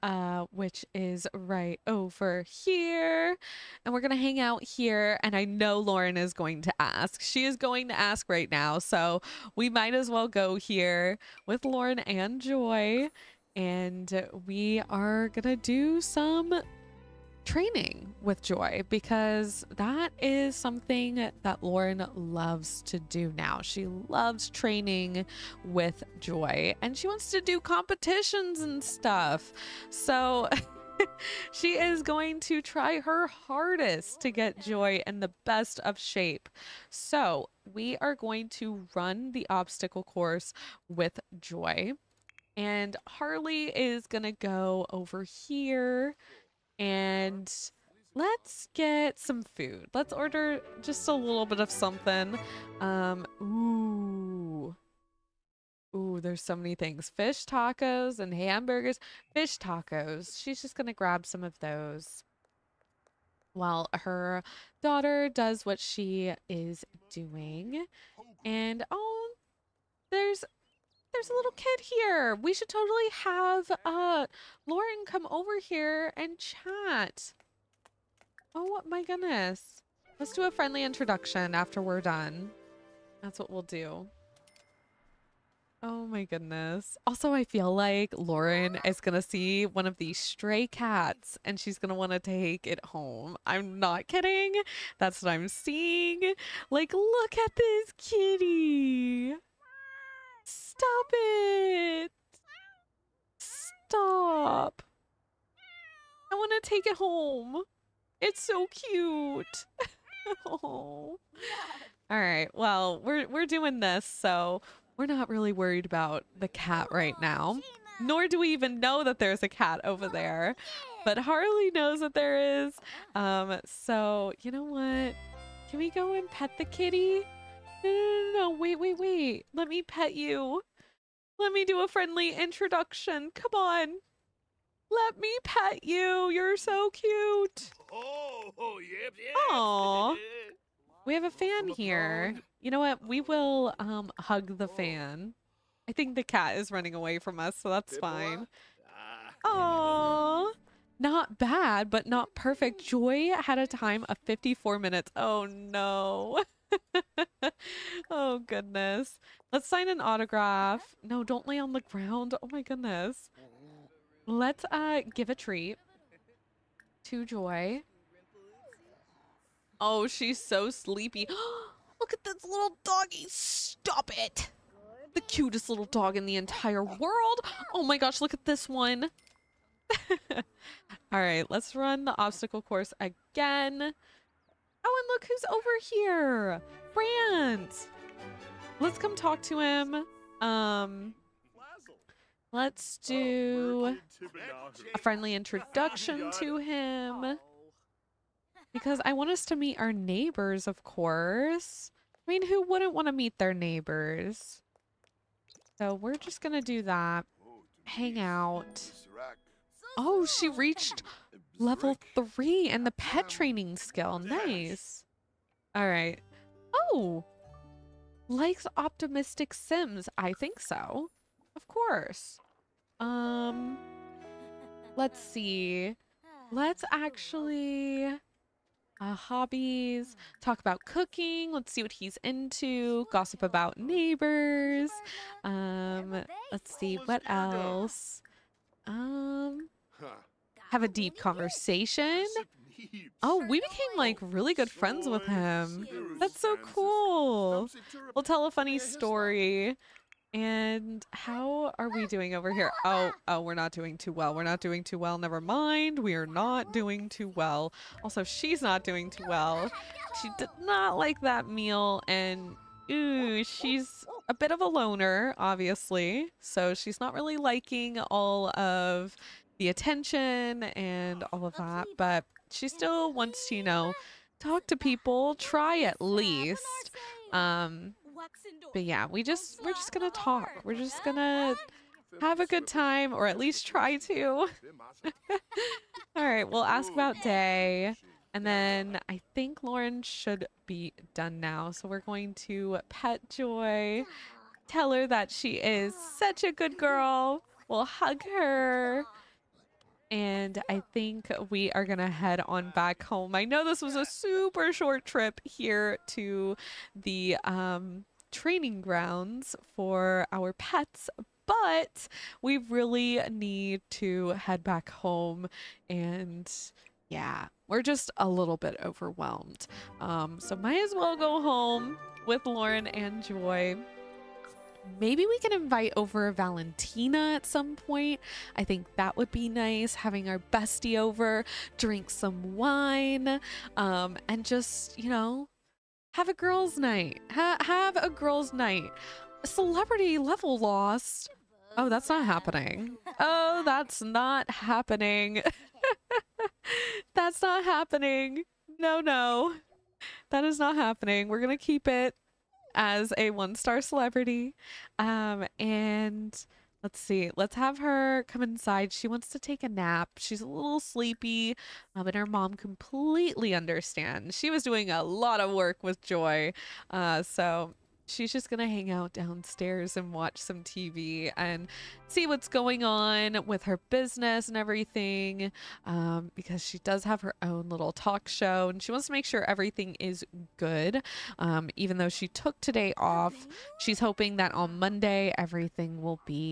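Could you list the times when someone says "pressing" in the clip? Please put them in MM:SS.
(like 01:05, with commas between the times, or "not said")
not said.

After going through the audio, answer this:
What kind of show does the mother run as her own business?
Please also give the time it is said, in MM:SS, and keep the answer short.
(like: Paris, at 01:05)
talk show, at 06:17.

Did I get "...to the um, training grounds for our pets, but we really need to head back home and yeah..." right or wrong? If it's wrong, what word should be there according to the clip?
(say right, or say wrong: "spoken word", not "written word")
right.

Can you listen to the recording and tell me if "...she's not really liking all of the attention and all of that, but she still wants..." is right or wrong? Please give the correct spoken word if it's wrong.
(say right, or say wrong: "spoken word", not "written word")
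right.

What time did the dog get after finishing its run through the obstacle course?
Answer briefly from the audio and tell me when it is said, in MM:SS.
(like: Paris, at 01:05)
54 minutes, at 02:34.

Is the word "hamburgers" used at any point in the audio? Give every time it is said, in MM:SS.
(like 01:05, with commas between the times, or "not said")
00:58.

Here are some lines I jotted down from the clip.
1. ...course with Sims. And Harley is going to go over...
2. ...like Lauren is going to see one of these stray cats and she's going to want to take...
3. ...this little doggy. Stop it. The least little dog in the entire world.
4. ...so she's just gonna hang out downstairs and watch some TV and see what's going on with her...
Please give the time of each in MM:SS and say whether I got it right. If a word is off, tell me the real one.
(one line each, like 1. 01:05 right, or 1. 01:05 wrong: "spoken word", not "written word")
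1. 00:40 wrong: "Joy", not "Sims"
2. 01:27 right
3. 02:52 wrong: "cutest", not "least"
4. 06:07 right.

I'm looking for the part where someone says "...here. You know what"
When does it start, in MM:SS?
02:21.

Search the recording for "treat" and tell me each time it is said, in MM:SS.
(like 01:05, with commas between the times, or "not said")
02:45.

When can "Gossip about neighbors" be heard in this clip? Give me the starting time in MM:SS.
03:53.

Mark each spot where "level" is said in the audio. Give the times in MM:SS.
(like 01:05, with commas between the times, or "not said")
03:31, 05:40.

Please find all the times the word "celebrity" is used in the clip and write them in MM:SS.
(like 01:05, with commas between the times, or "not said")
05:39, 05:53.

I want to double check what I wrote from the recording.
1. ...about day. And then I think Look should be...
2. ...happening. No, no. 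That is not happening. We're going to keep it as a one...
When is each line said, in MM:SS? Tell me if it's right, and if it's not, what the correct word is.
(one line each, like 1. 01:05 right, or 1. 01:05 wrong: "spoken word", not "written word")
1. 04:46 wrong: "Lauren", not "Look"
2. 05:47 right.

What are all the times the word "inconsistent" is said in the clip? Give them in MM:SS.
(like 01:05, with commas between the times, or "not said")
not said.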